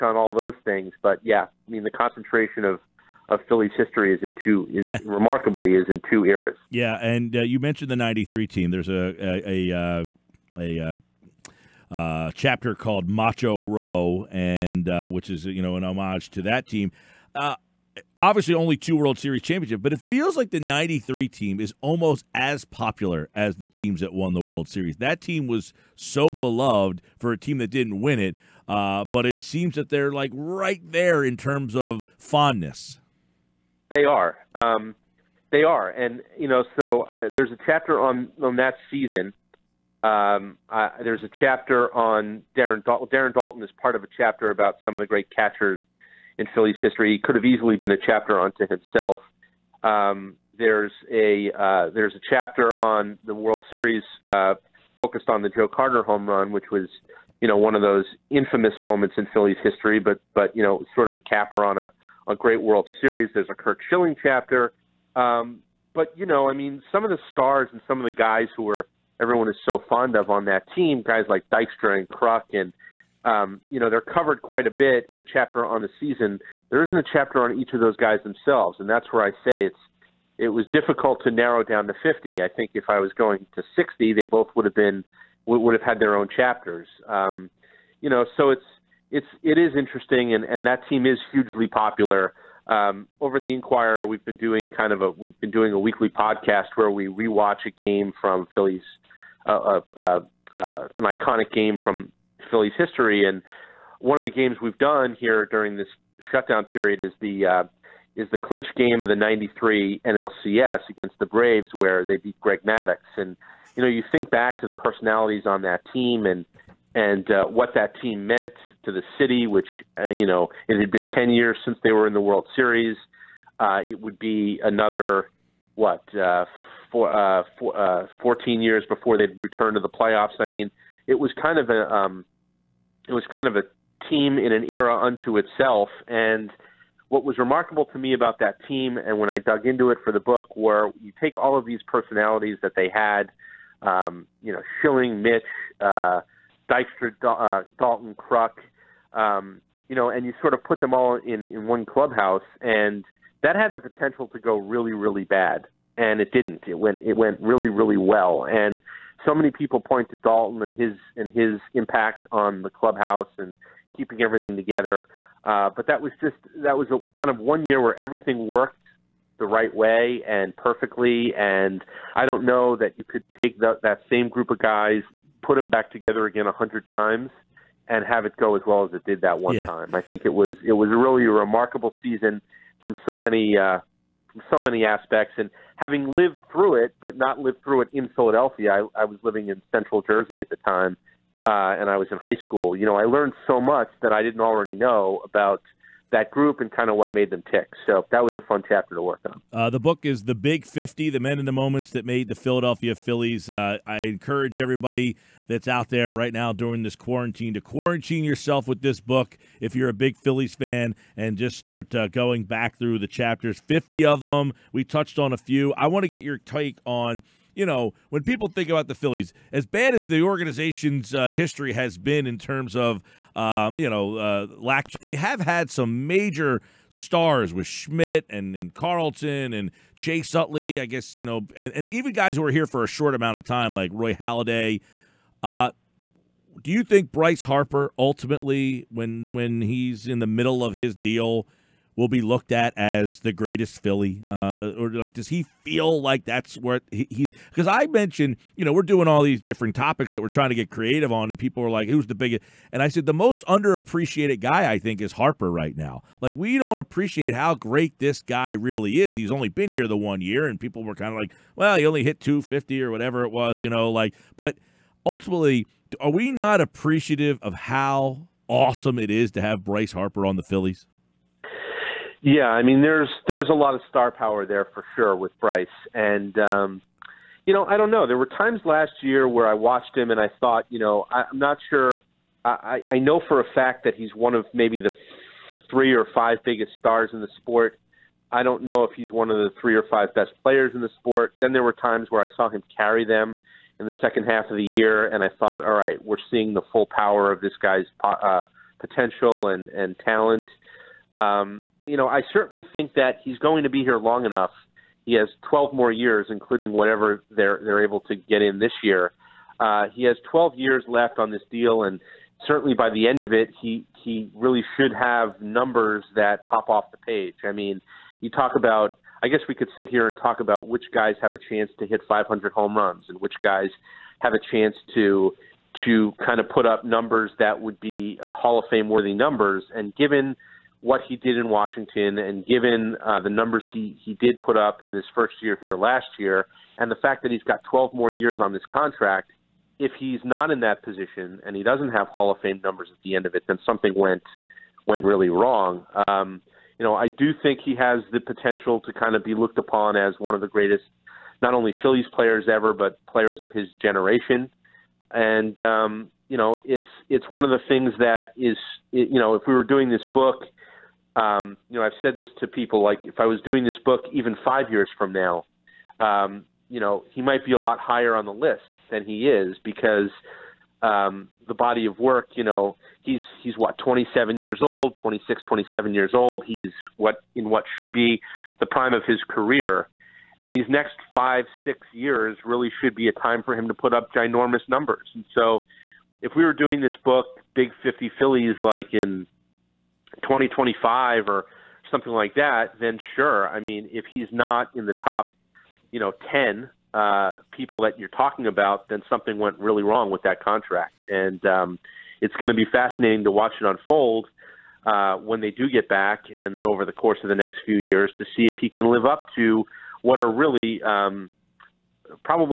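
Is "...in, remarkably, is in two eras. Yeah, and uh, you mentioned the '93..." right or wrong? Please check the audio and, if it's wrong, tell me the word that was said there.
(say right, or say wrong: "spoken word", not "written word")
right.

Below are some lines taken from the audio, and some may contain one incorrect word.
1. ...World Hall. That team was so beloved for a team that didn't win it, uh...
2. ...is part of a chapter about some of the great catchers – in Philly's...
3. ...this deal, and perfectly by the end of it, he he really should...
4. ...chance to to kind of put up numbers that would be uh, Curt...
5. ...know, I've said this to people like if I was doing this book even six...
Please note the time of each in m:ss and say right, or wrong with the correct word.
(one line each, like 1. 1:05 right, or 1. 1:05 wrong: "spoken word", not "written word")
1. 0:24 wrong: "Series", not "Hall"
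2. 0:43 right
3. 5:11 wrong: "certainly", not "perfectly"
4. 5:24 wrong: "Hall", not "Curt"
5. 6:01 wrong: "five", not "six".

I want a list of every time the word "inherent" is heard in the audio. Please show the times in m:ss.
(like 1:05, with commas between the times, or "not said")
not said.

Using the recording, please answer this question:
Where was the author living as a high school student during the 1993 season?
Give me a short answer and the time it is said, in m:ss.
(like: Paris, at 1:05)
Central Jersey, at 3:09.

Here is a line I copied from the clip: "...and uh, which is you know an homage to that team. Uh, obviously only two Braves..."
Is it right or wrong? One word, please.
wrong.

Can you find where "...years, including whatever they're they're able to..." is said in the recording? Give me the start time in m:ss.
5:05.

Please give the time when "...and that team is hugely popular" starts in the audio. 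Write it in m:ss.
1:30.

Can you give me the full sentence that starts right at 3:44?
They have had some major stars with Schmidt and, and Carlton and Chase Utley.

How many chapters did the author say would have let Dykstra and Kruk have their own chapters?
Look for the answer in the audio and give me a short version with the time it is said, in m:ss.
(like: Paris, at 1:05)
60, at 1:23.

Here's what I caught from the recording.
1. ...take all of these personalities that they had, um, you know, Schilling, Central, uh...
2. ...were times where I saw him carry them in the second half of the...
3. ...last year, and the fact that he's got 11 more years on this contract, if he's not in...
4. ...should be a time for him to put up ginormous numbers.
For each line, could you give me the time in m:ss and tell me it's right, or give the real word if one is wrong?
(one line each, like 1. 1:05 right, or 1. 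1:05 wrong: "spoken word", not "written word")
1. 2:21 wrong: "Mitch", not "Central"
2. 4:51 right
3. 5:35 wrong: "12", not "11"
4. 6:22 right.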